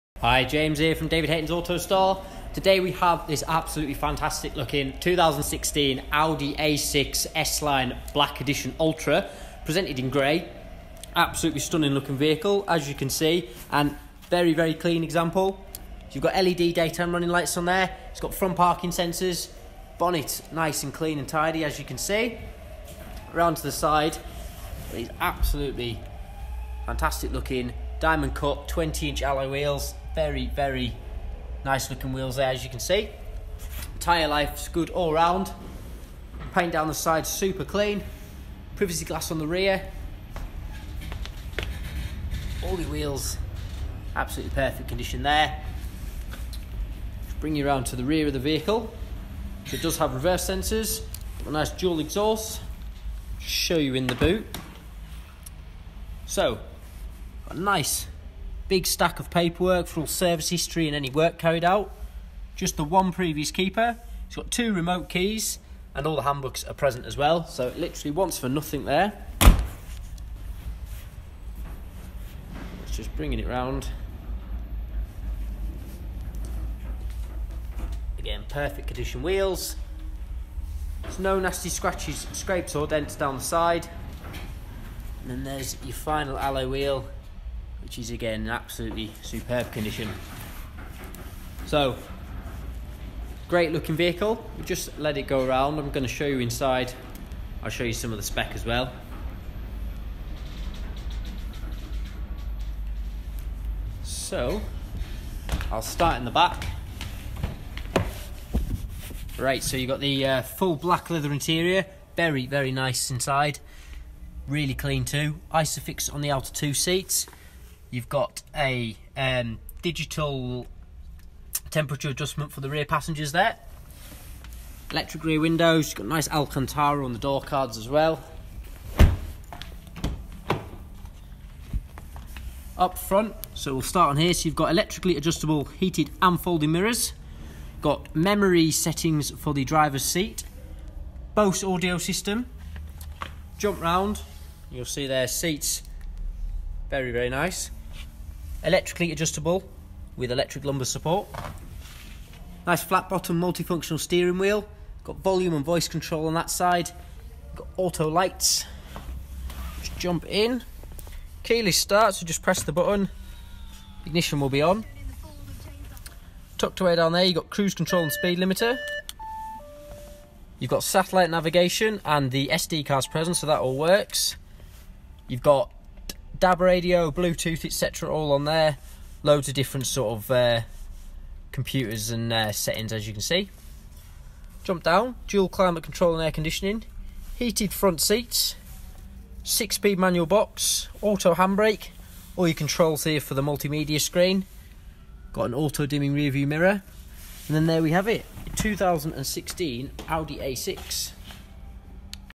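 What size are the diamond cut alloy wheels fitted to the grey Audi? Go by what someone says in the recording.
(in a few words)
20 inch.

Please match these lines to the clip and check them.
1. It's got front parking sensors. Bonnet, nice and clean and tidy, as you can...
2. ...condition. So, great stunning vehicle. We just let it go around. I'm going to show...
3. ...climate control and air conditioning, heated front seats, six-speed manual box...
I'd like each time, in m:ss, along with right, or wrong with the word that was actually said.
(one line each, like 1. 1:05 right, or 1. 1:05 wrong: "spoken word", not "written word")
1. 0:18 right
2. 1:29 wrong: "looking", not "stunning"
3. 3:05 right.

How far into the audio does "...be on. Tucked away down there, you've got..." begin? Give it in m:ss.
2:44.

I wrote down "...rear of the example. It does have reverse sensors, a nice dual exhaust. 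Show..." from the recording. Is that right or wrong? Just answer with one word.
wrong.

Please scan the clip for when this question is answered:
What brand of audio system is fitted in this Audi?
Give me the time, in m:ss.
2:21.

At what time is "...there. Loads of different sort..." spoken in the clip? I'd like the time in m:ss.
2:58.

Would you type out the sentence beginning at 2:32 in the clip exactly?
Nice flat bottom multifunctional steering wheel.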